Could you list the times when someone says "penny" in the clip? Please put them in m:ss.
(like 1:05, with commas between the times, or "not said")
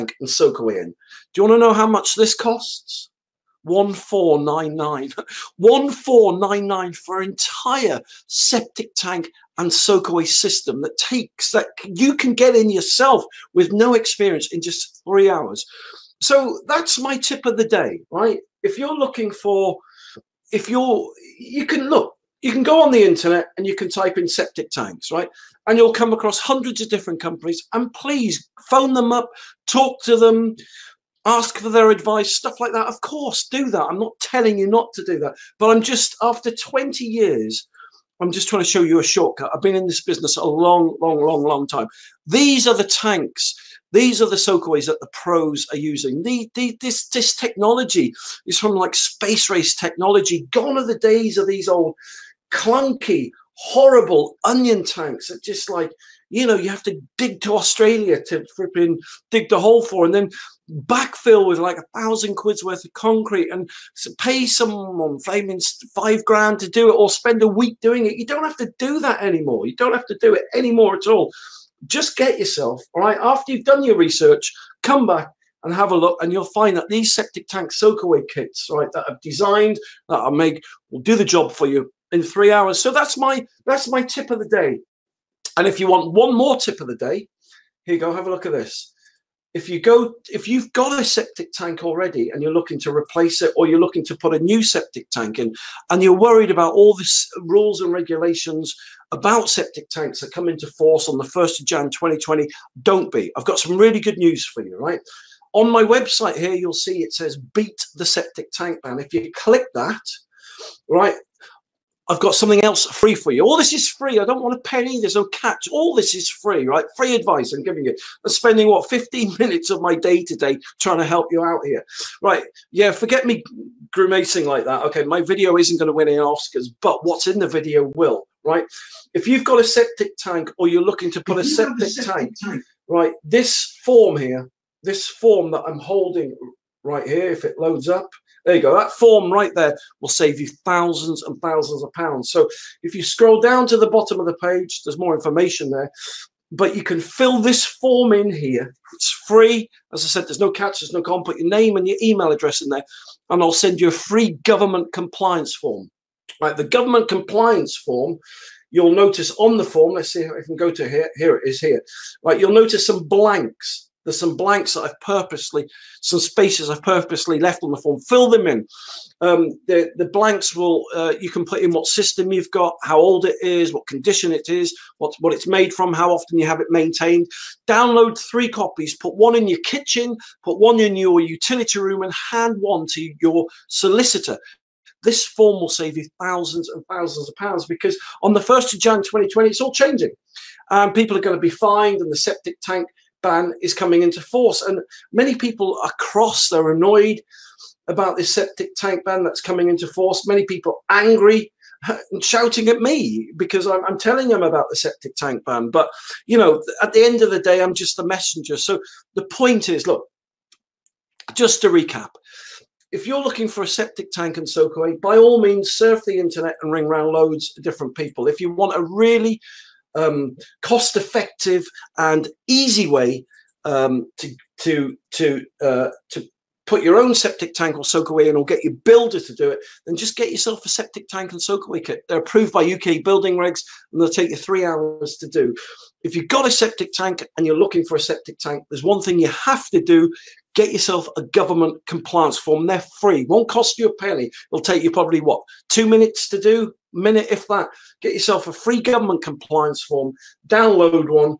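1:54, 4:03.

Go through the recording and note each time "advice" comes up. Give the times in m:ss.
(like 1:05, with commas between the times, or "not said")
0:31, 1:57.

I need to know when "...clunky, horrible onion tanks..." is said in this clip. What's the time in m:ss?
0:52.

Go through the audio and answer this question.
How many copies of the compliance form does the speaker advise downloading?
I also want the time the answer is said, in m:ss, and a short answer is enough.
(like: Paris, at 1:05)
3, at 2:58.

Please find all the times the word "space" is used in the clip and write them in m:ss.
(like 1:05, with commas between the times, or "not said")
0:48, 2:46.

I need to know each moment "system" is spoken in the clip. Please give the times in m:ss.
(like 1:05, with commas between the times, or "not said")
0:10, 2:51.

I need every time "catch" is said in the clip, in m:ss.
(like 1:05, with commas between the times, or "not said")
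1:55, 2:30.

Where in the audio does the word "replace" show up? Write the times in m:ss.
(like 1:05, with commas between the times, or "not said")
1:32.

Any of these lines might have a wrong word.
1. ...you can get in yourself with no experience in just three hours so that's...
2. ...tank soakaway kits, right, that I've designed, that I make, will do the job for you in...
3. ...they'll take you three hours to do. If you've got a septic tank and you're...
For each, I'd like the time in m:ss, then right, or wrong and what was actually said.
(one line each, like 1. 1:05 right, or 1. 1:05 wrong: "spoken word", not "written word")
1. 0:11 right
2. 1:17 right
3. 3:54 right.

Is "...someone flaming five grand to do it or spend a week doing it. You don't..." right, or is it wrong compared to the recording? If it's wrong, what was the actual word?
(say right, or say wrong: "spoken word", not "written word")
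right.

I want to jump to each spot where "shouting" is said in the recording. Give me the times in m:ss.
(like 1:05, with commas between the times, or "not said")
3:22.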